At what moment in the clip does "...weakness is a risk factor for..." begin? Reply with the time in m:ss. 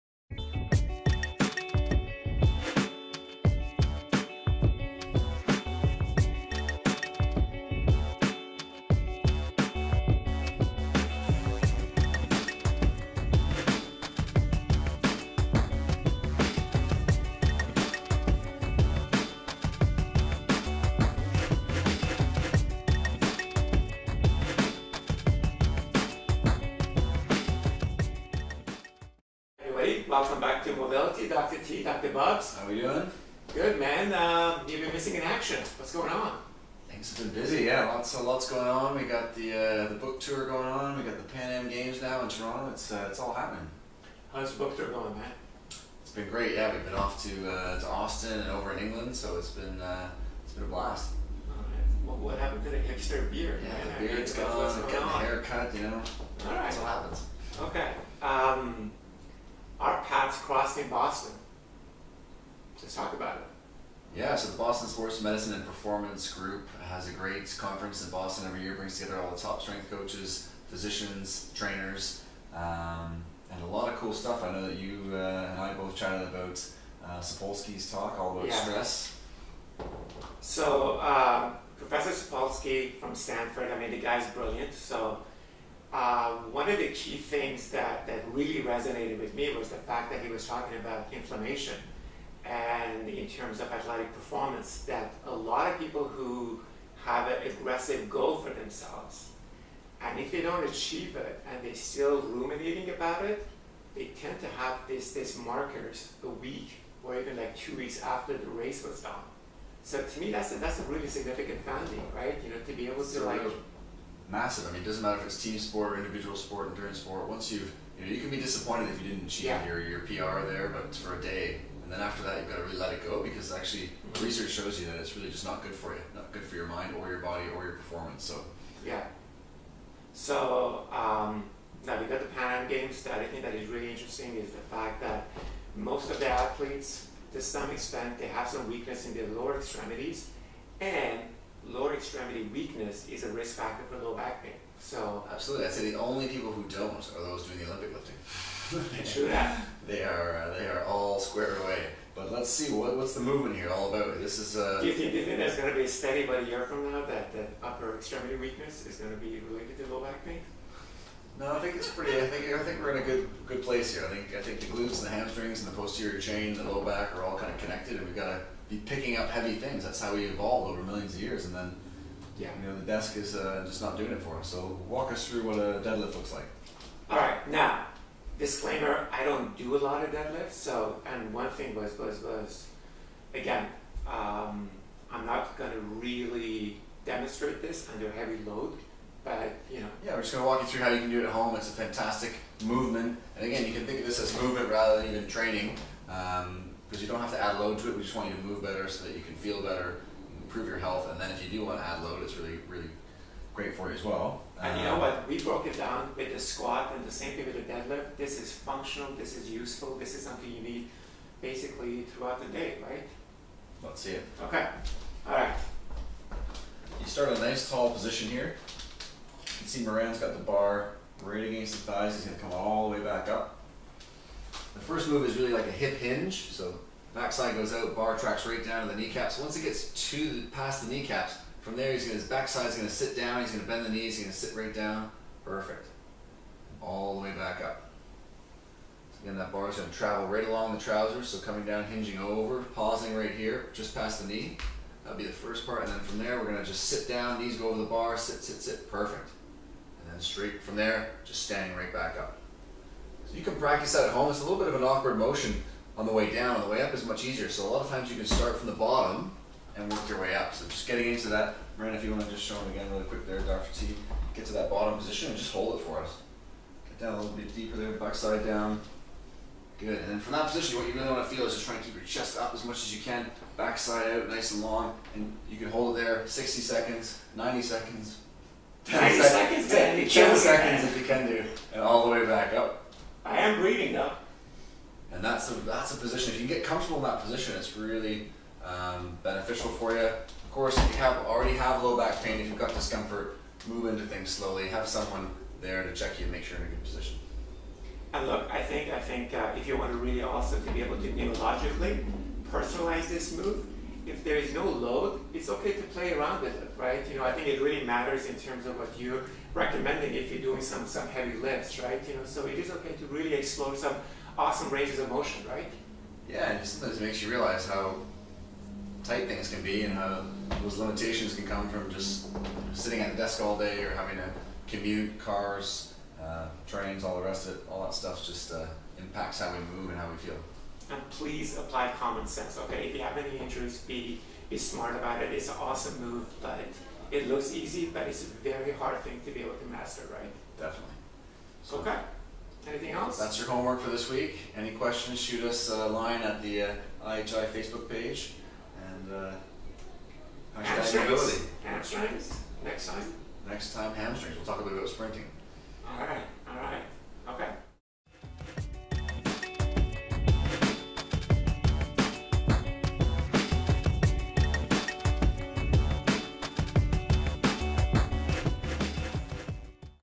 2:22.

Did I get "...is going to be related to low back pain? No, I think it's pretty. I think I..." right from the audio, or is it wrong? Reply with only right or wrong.
right.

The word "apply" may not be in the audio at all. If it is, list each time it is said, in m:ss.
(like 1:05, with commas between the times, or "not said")
5:31.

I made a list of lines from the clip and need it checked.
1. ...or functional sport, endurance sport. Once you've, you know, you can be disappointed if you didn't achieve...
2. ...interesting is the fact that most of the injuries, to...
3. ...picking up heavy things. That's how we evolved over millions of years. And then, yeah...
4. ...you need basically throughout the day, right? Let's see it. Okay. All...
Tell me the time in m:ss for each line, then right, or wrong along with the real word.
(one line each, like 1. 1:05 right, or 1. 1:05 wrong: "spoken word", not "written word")
1. 1:55 wrong: "individual", not "functional"
2. 2:13 wrong: "athletes", not "injuries"
3. 2:48 right
4. 3:30 right.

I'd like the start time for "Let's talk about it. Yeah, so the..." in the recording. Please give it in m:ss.
1:02.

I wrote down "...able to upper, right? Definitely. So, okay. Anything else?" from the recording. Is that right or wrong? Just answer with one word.
wrong.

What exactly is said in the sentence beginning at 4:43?
I am breathing now and that's a that's a position.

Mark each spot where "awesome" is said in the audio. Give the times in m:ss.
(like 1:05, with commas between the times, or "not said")
5:14, 5:35.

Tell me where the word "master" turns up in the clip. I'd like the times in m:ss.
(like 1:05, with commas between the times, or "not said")
5:39.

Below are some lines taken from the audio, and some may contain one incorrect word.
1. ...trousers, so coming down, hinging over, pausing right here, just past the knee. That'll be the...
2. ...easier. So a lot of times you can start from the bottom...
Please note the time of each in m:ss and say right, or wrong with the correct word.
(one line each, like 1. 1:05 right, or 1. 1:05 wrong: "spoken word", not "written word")
1. 4:00 right
2. 4:17 right.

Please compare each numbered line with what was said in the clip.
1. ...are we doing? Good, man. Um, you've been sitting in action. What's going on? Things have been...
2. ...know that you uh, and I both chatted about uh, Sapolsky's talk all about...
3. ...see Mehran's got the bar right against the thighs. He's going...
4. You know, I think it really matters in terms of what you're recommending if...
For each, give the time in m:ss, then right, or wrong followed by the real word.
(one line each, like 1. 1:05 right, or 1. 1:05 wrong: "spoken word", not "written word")
1. 0:32 wrong: "missing", not "sitting"
2. 1:14 right
3. 3:39 right
4. 5:07 right.